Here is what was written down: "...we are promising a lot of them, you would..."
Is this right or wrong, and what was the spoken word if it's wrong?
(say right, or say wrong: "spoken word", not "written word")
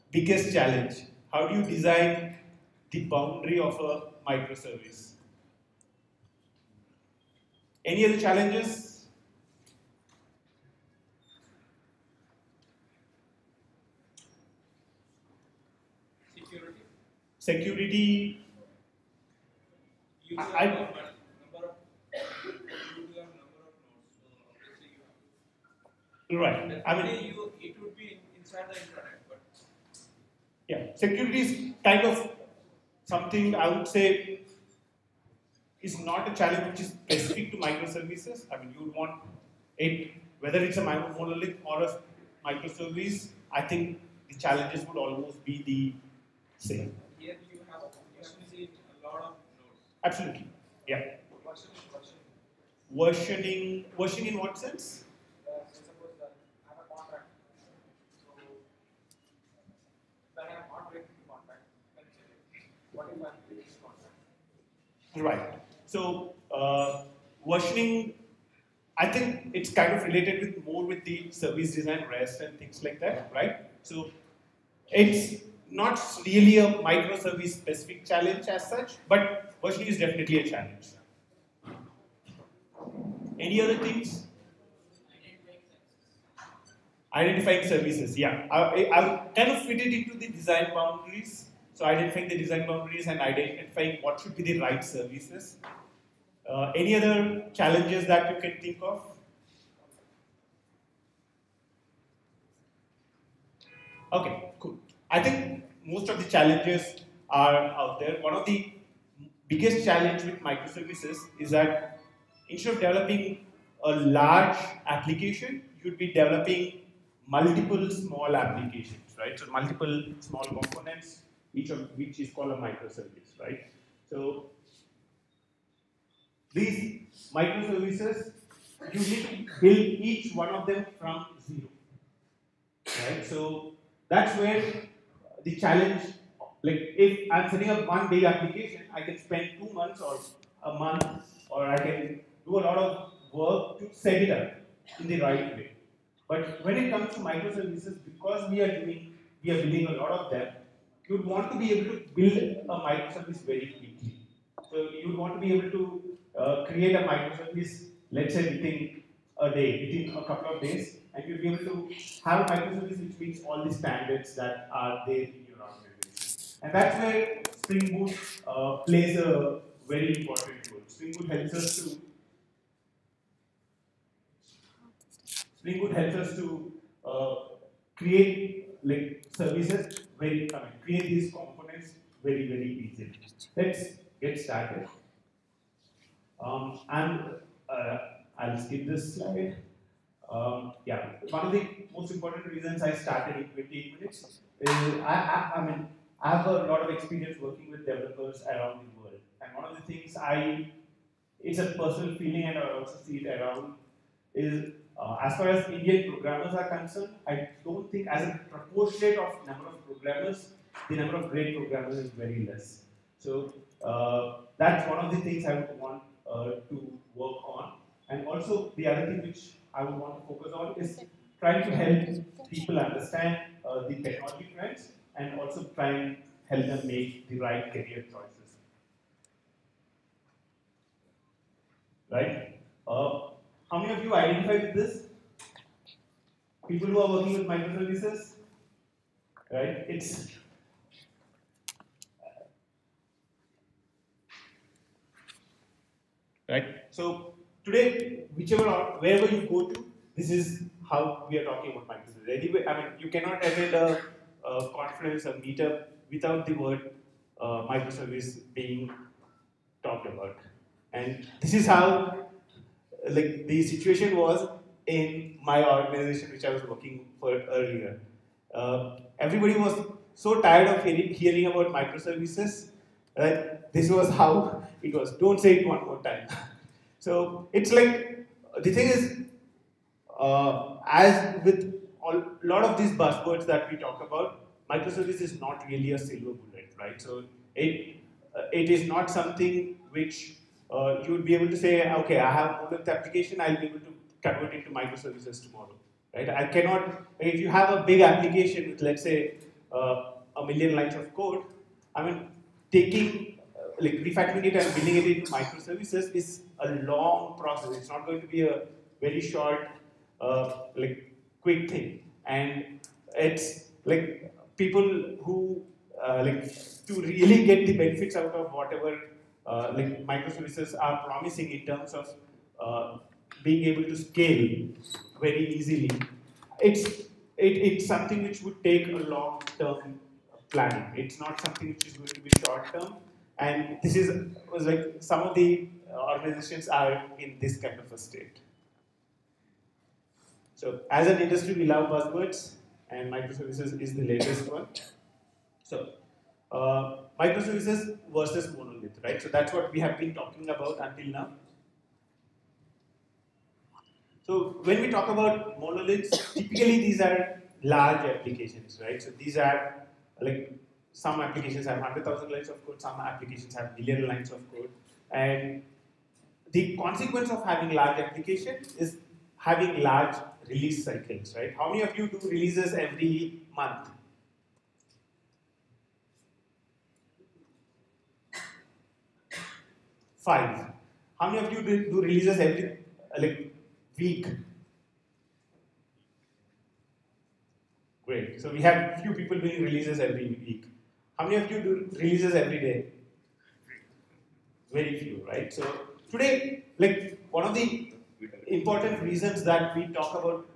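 wrong: "building", not "promising".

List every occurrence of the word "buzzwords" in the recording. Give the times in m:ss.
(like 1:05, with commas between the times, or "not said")
4:42, 5:41.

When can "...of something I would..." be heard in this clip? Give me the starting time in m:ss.
0:32.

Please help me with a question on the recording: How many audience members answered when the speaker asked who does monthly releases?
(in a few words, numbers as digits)
5.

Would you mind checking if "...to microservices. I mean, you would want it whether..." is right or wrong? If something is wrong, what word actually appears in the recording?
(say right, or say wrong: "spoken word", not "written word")
right.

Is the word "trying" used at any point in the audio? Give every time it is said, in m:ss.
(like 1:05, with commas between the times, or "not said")
3:41, 3:45.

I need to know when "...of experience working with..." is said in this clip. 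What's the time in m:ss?
3:16.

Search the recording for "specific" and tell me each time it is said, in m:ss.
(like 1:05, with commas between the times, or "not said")
0:36, 1:17.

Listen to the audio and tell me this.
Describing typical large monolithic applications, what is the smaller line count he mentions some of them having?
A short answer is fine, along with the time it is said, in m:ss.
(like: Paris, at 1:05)
100,000 lines, at 6:01.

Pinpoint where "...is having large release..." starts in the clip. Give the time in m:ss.
6:08.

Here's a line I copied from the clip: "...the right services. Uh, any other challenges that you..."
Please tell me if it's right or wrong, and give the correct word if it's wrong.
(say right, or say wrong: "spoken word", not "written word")
right.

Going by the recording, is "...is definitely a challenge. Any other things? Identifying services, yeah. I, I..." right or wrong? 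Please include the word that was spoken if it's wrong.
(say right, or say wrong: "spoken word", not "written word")
right.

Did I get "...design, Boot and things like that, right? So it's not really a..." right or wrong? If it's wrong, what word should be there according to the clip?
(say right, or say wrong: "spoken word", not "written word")
wrong: "REST", not "Boot".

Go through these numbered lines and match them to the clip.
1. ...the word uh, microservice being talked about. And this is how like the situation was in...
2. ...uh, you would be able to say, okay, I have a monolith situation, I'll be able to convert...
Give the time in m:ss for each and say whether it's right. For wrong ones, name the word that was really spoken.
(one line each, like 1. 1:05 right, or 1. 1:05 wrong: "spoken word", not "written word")
1. 4:16 right
2. 4:50 wrong: "application", not "situation".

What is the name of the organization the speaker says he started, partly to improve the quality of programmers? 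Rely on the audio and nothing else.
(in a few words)
in 28 minutes.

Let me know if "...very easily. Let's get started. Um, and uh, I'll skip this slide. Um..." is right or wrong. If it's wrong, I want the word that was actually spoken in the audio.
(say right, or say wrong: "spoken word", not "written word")
right.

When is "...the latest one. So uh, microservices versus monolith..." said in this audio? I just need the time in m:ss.
5:43.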